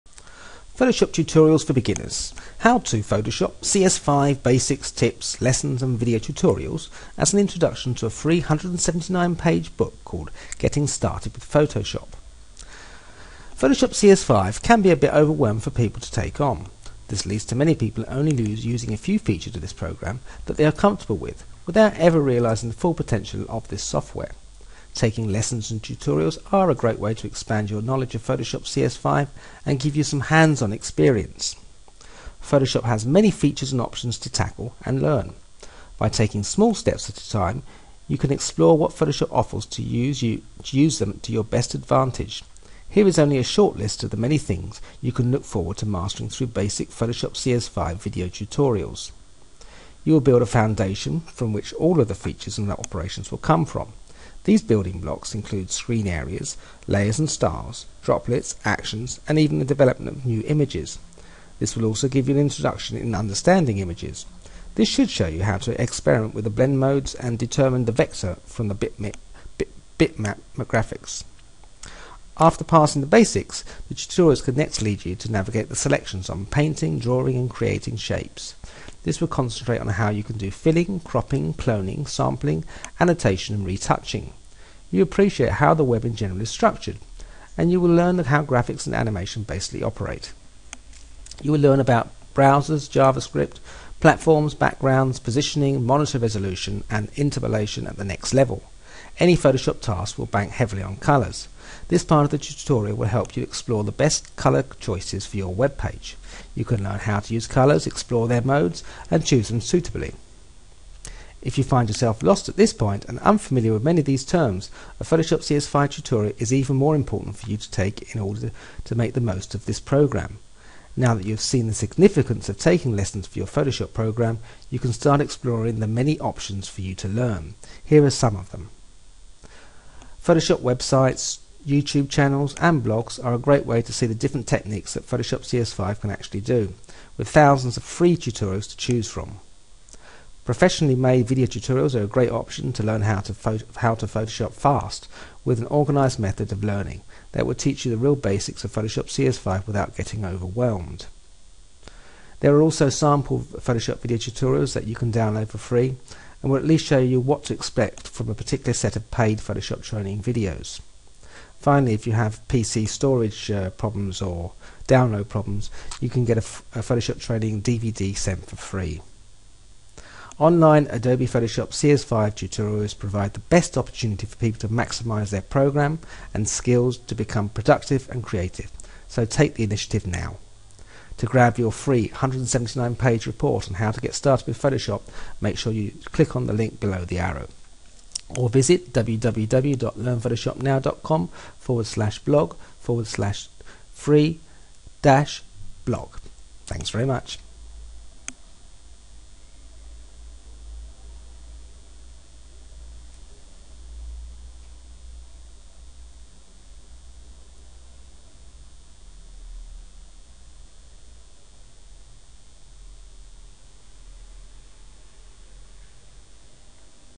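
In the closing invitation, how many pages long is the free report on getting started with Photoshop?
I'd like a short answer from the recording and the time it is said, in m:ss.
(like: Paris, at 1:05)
179, at 3:02.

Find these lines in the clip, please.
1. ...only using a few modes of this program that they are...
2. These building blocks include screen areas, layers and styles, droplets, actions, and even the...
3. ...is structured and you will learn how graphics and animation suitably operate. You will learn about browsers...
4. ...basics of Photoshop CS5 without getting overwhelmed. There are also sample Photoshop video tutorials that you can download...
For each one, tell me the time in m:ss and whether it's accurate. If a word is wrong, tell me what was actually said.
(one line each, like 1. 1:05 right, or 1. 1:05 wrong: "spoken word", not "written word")
1. 0:18 wrong: "features", not "modes"
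2. 0:54 right
3. 1:26 wrong: "basically", not "suitably"
4. 2:28 right.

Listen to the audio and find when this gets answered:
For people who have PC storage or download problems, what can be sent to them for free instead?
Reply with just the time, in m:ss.
2:46.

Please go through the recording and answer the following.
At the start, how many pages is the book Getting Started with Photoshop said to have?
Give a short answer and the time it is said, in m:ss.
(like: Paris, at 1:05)
379, at 0:08.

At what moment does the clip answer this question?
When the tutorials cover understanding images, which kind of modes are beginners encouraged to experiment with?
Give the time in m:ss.
1:06.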